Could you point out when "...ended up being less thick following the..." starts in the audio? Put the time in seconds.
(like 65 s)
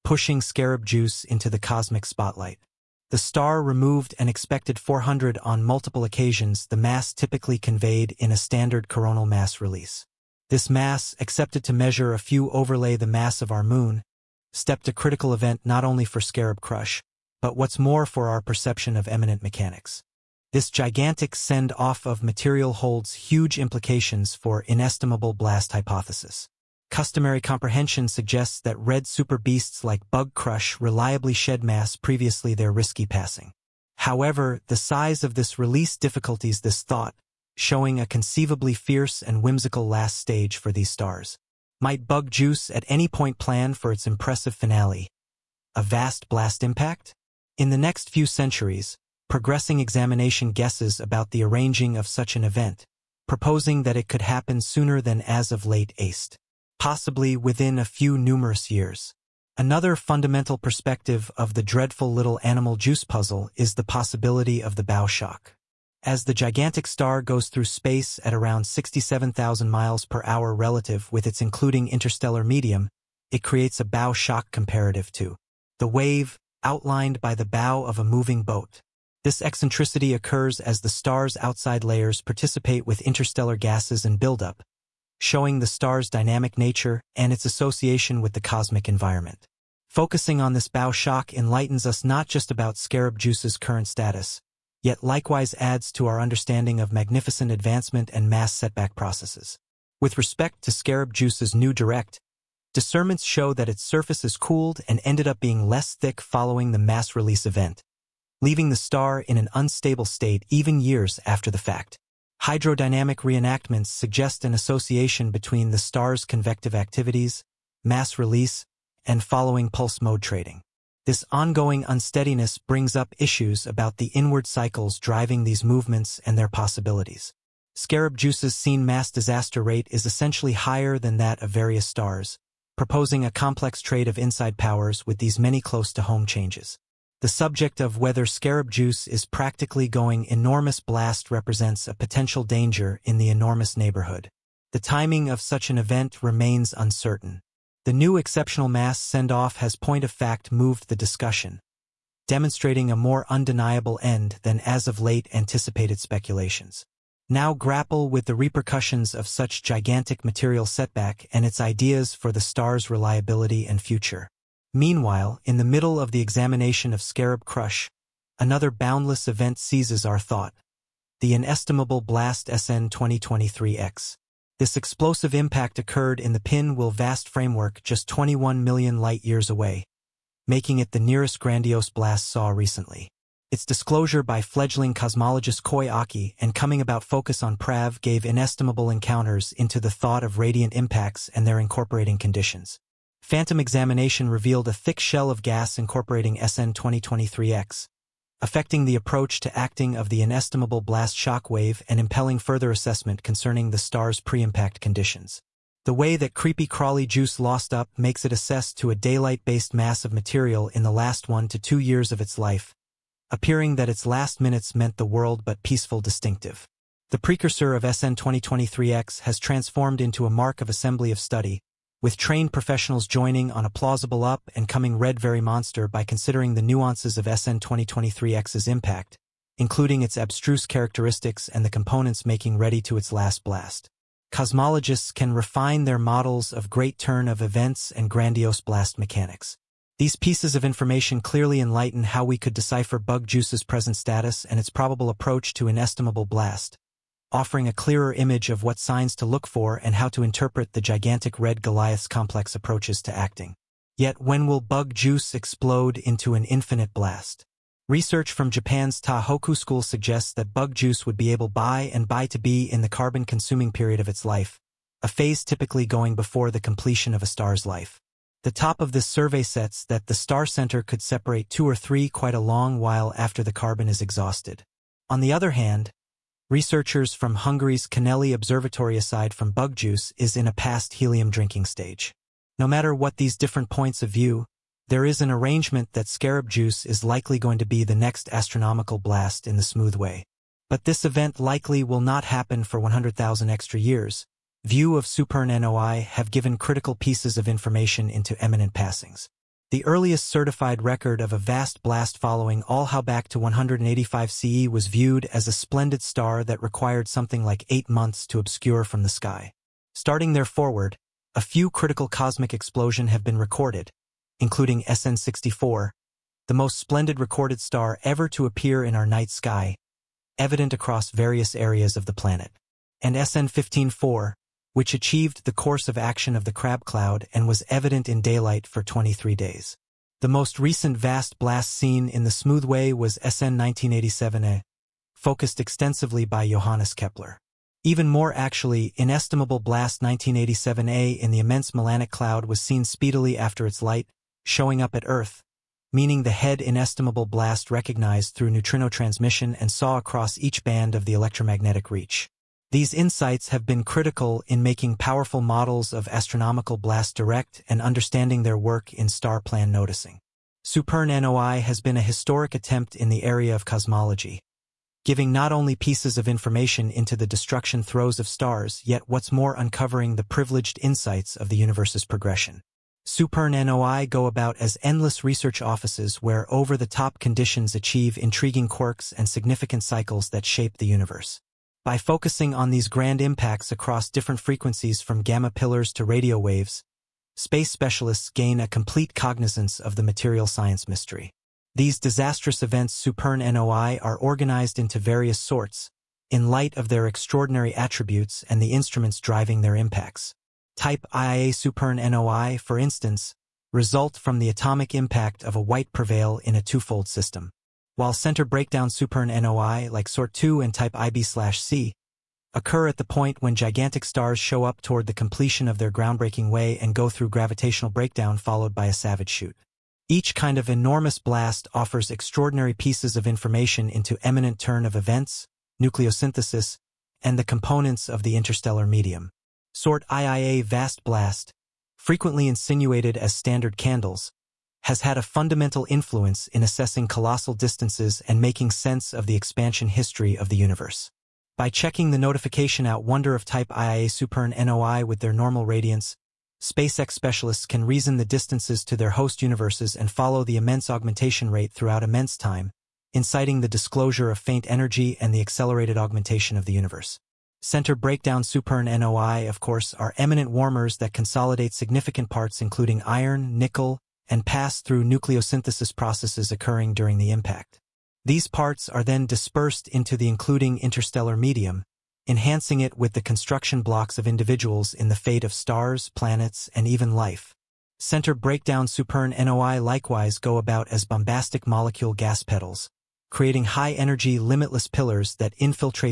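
105 s.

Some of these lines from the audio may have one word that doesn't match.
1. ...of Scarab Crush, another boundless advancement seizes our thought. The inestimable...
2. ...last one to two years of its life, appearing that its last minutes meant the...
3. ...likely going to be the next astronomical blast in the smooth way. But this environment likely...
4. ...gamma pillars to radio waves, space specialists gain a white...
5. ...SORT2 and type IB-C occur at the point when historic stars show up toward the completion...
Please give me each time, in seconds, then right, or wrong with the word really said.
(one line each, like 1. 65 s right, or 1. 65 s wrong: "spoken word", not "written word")
1. 166 s wrong: "event", not "advancement"
2. 210 s right
3. 287 s wrong: "event", not "environment"
4. 385 s wrong: "complete", not "white"
5. 410 s wrong: "gigantic", not "historic".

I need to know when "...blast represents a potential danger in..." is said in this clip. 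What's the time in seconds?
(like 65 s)
140 s.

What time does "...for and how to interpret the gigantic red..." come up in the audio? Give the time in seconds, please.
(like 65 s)
249 s.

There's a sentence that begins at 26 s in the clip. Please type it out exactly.
Customary comprehension suggests that red super beasts like Bug Crush reliably shed mass previously their risky passing.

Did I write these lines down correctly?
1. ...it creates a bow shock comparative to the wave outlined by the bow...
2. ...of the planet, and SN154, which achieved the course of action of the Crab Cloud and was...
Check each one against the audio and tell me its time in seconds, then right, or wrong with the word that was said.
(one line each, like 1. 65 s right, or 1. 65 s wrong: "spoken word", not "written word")
1. 73 s right
2. 321 s right.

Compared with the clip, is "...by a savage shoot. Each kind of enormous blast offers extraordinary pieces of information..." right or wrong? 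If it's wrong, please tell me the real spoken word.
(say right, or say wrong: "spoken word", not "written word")
right.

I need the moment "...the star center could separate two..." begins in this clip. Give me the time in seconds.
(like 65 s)
270 s.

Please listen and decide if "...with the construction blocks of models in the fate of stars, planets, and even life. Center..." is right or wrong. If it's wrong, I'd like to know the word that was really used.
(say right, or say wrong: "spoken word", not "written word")
wrong: "individuals", not "models".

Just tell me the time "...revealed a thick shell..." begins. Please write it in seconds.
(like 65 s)
194 s.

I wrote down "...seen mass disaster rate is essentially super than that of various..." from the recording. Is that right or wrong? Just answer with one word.
wrong.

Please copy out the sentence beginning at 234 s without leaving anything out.
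Cosmologists can refine their models of great turn of events and grandiose blast mechanics.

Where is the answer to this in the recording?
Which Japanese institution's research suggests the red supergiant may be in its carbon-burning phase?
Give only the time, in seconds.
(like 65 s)
259 s.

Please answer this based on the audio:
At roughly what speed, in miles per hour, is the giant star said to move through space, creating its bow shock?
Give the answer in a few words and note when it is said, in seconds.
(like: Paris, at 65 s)
67,000 miles per hour, at 68 s.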